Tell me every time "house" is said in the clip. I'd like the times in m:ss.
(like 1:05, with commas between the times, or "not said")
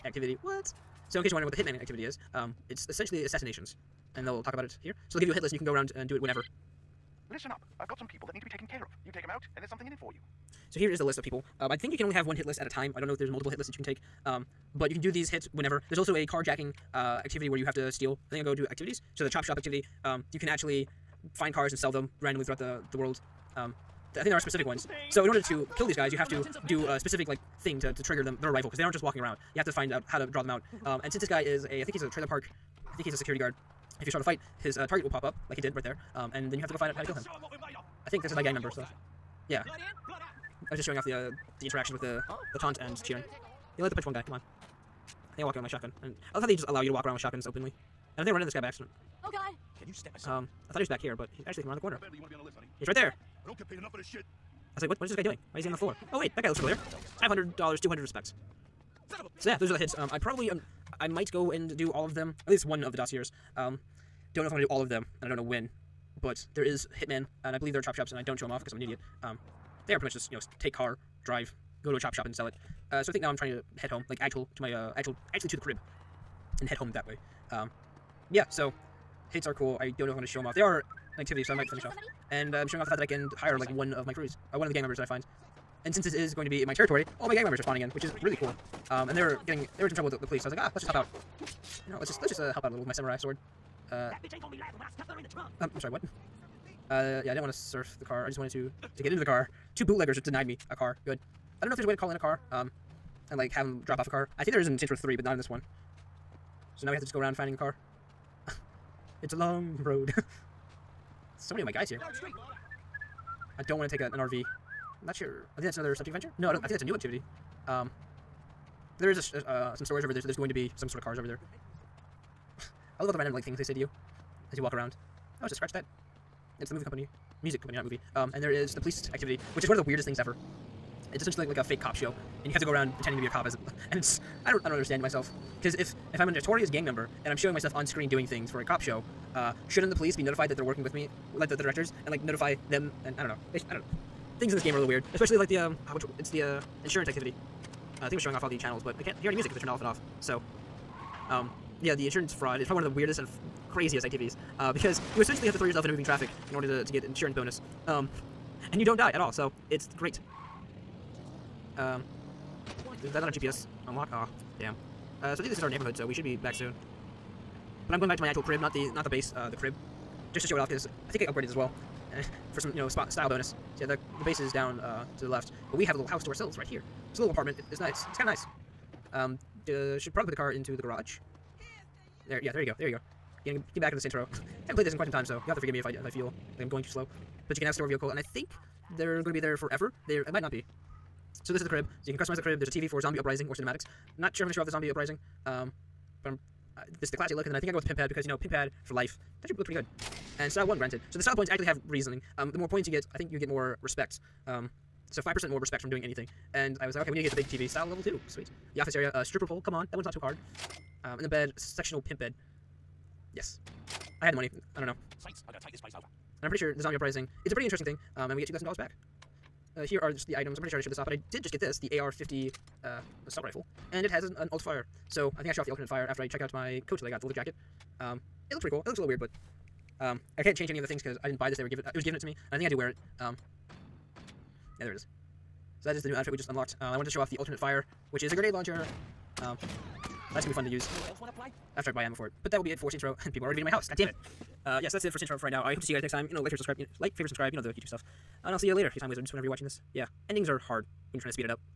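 2:56, 4:03.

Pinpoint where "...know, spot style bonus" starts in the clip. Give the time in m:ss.
2:52.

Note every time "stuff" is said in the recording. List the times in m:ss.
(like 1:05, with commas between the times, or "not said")
1:34, 4:07.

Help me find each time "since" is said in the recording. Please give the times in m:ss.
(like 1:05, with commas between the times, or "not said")
0:31, 1:25.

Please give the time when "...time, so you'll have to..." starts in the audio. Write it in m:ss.
3:05.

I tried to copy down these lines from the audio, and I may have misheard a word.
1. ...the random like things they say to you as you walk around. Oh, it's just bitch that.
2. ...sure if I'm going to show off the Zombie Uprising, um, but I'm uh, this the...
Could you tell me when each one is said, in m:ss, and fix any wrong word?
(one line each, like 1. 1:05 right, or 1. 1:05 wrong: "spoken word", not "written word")
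1. 2:03 wrong: "scratch", not "bitch"
2. 3:14 right.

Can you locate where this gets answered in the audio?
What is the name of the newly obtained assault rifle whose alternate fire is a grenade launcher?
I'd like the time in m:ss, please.
3:41.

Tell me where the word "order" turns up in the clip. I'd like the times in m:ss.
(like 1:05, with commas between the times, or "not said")
0:25, 2:36.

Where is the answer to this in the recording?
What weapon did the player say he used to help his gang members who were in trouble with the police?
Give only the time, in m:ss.
1:32.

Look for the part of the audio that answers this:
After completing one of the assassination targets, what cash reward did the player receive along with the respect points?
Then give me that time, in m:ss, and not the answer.
0:57.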